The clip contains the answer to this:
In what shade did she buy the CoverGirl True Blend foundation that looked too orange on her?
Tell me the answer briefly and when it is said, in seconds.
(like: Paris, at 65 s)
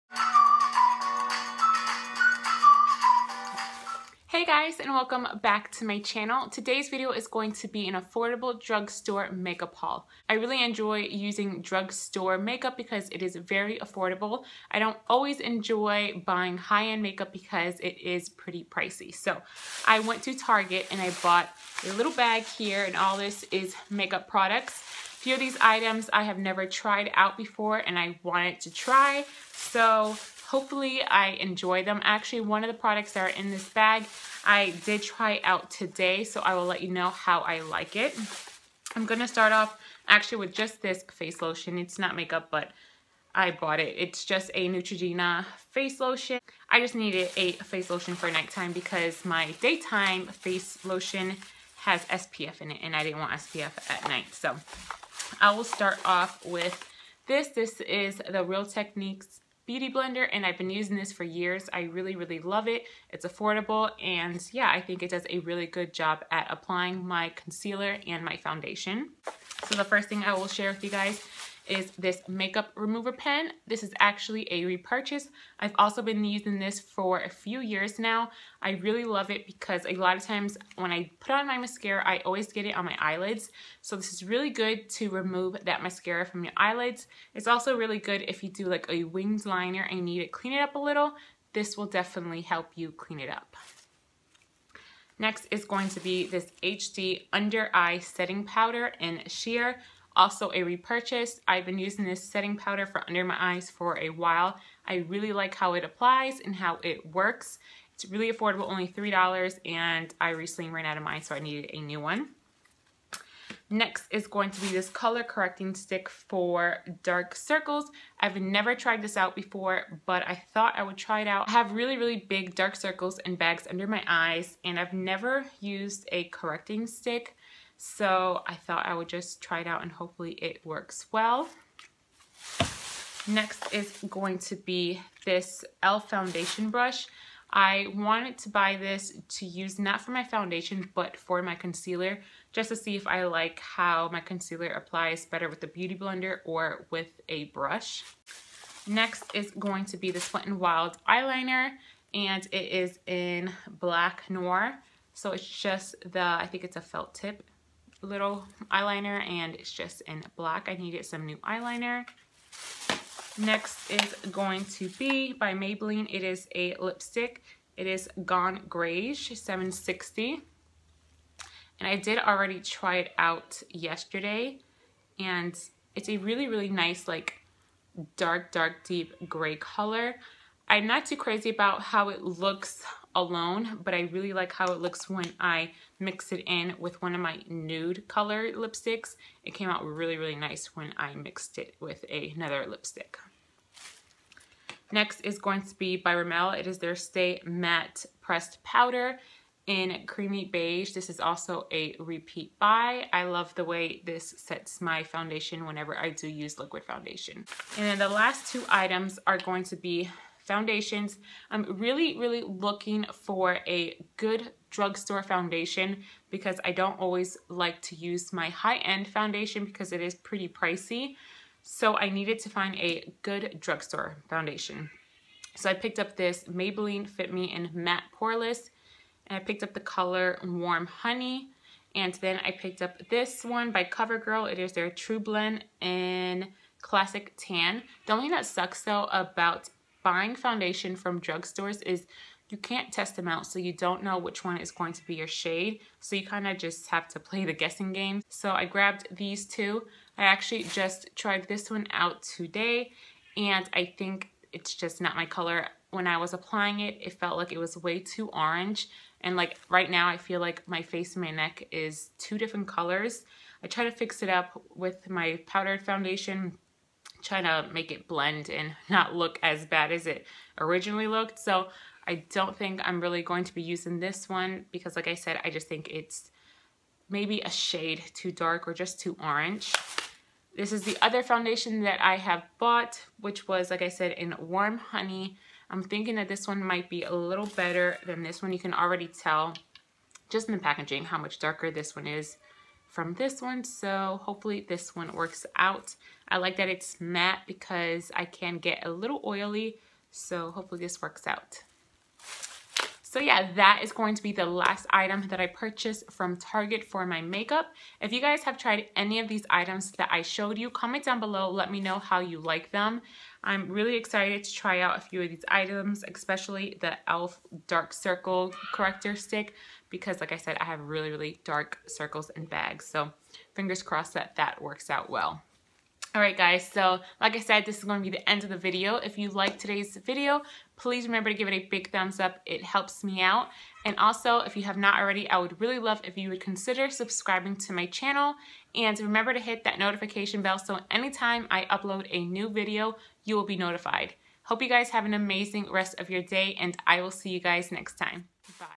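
Classic Tan, at 236 s.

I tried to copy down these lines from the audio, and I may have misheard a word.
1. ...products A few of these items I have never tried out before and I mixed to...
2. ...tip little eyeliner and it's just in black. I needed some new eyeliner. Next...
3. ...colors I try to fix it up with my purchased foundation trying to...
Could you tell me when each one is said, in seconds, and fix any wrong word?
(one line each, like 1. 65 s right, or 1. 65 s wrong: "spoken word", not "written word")
1. 24 s wrong: "wanted", not "mixed"
2. 157 s right
3. 262 s wrong: "powdered", not "purchased".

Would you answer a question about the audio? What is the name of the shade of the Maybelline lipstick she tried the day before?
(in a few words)
Gone Grayish 760.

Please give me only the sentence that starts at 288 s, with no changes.
You can already tell just in the packaging how much darker this one is from this one.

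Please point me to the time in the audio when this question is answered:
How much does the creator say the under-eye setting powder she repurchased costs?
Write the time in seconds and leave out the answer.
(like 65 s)
108 s.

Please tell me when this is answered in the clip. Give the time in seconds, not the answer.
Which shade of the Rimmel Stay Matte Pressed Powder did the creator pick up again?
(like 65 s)
200 s.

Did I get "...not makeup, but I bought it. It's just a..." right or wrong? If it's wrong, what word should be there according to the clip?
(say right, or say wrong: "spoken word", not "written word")
right.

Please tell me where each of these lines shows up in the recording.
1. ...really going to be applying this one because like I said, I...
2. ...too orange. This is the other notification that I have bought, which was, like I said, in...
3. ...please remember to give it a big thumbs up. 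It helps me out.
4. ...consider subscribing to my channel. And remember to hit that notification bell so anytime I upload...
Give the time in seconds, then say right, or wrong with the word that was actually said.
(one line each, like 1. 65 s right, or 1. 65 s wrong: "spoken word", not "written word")
1. 273 s wrong: "using", not "applying"
2. 278 s wrong: "foundation", not "notification"
3. 330 s right
4. 336 s right.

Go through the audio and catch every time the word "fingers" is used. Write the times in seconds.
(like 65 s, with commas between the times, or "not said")
323 s.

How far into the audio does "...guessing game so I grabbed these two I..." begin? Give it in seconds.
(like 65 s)
247 s.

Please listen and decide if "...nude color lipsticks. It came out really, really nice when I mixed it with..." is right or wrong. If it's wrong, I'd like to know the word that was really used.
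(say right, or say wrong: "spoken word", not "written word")
right.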